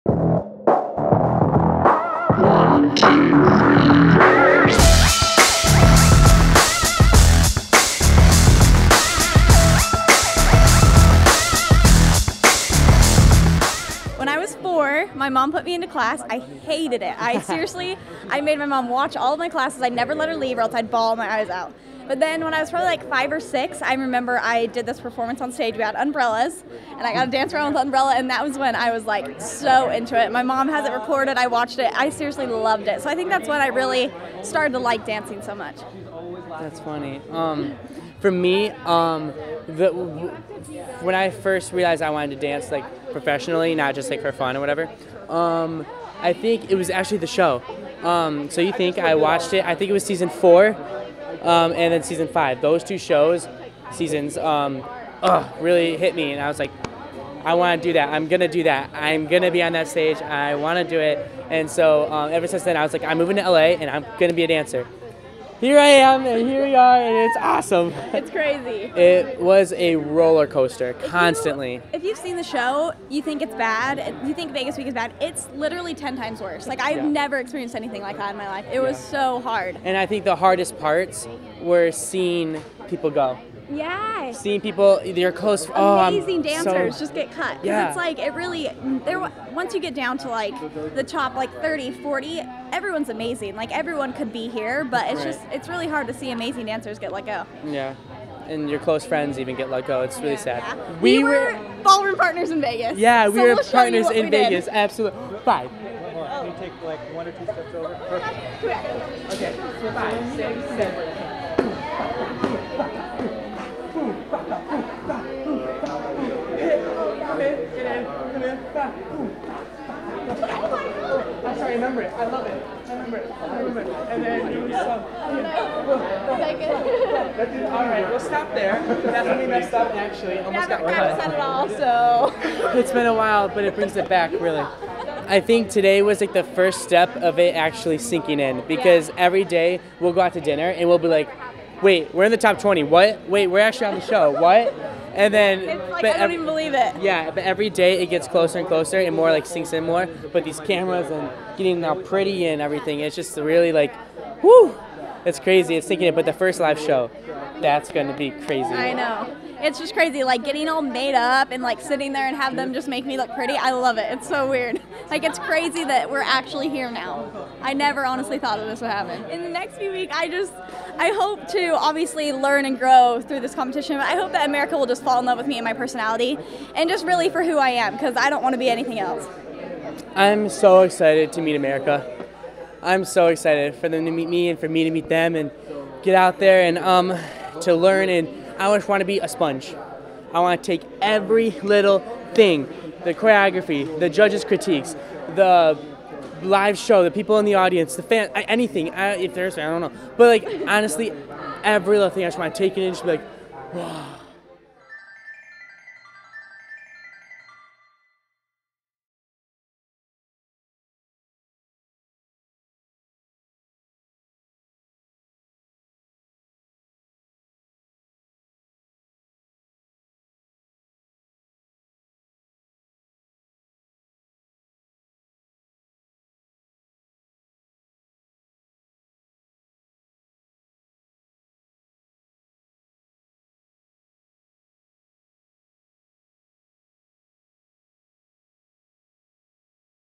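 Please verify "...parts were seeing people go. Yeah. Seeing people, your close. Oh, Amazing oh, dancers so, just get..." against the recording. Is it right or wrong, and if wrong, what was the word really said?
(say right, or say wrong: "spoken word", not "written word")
right.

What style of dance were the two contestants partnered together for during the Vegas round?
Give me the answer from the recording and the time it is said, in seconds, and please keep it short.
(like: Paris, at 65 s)
Ballroom, at 101 s.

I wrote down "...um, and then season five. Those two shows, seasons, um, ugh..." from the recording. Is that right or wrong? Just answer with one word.
right.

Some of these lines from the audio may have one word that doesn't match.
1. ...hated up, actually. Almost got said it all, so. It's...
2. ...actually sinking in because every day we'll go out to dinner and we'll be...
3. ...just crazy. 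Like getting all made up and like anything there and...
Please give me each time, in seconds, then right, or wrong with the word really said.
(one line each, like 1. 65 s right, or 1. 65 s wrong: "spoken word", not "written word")
1. 129 s wrong: "messed", not "hated"
2. 137 s right
3. 159 s wrong: "sitting", not "anything".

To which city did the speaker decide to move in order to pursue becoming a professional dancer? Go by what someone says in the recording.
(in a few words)
LA.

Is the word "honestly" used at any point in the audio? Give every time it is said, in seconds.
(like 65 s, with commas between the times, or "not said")
168 s, 200 s.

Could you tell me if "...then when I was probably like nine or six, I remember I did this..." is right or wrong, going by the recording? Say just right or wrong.
wrong.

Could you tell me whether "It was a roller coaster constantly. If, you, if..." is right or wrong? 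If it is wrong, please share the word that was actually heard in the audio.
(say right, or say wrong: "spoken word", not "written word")
right.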